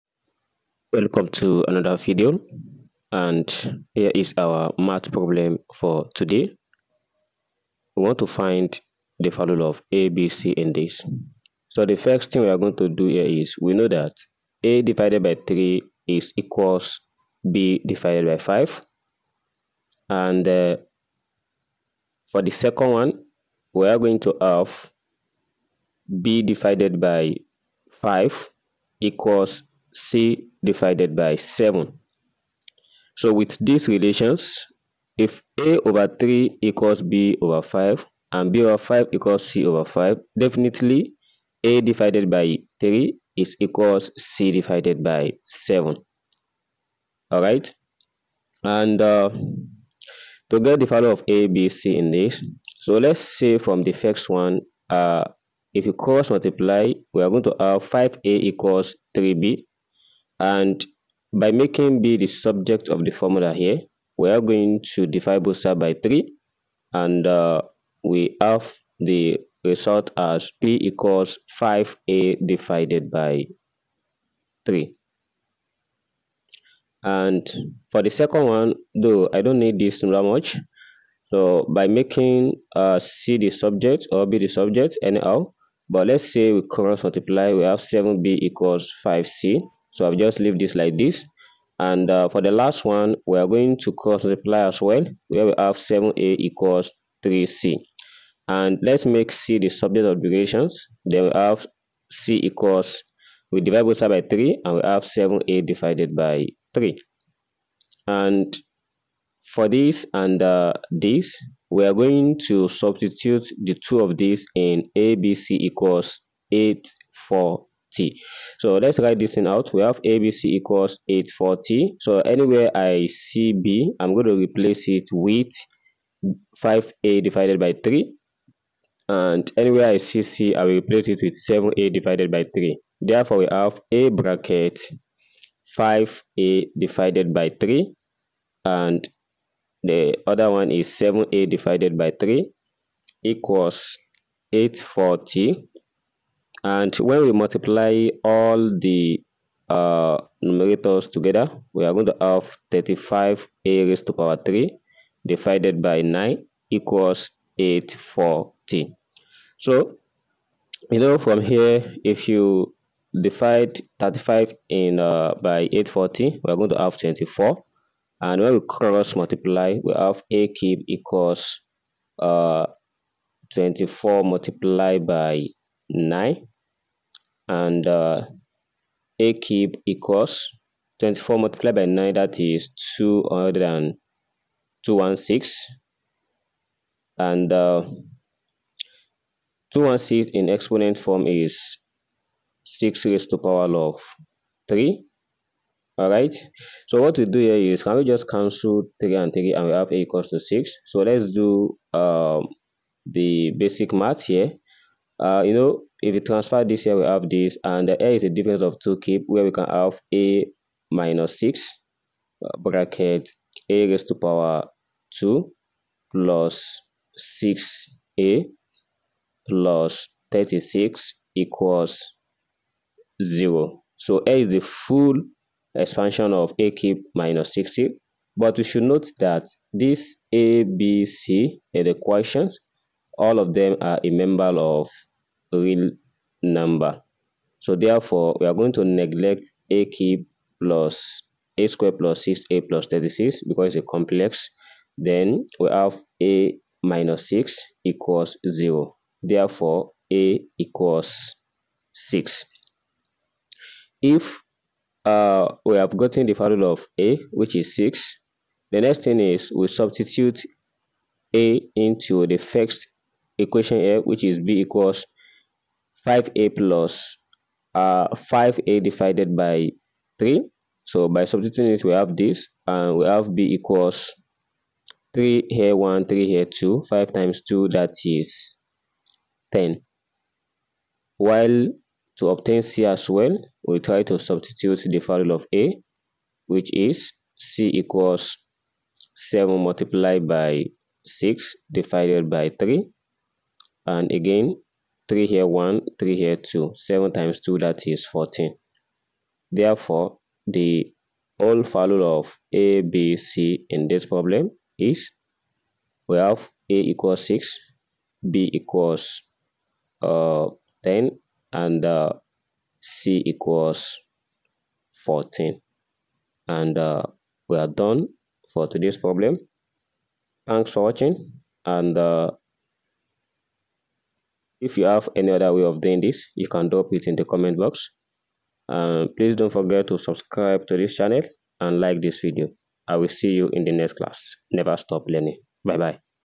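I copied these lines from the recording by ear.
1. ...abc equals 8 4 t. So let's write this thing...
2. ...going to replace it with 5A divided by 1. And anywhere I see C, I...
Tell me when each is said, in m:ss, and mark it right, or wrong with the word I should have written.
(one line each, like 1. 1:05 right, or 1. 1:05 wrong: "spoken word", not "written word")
1. 1:54 right
2. 2:04 wrong: "3", not "1".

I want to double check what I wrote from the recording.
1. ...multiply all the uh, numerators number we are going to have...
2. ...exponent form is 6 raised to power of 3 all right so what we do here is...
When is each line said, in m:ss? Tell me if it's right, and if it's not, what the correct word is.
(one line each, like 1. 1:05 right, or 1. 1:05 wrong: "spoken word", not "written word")
1. 2:27 wrong: "together", not "number"
2. 3:10 right.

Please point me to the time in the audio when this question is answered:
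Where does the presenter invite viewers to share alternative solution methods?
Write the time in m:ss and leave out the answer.
5:27.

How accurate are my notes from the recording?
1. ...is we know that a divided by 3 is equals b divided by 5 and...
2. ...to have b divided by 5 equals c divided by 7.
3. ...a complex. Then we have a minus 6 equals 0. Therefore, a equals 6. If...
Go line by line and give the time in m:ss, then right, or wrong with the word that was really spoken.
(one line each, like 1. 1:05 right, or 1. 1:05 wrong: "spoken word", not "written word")
1. 0:13 right
2. 0:24 right
3. 4:03 right.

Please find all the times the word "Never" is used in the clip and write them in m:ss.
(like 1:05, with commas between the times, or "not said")
5:34.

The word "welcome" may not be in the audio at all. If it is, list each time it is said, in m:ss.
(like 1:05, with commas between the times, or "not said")
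0:00.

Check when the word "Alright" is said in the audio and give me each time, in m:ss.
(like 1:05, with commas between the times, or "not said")
0:47.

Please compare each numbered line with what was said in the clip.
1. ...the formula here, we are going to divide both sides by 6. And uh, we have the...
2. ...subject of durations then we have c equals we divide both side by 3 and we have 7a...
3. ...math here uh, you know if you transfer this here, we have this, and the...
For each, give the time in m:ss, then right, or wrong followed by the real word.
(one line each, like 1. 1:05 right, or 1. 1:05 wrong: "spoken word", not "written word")
1. 1:03 wrong: "3", not "6"
2. 1:39 right
3. 3:23 right.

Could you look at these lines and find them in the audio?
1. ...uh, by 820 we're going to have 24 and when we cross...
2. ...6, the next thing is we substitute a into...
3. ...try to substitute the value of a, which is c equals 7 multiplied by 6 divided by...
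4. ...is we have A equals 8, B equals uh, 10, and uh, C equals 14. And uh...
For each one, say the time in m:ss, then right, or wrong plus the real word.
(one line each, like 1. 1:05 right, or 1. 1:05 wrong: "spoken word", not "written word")
1. 2:44 wrong: "840", not "820"
2. 4:17 right
3. 4:43 right
4. 5:04 wrong: "6", not "8".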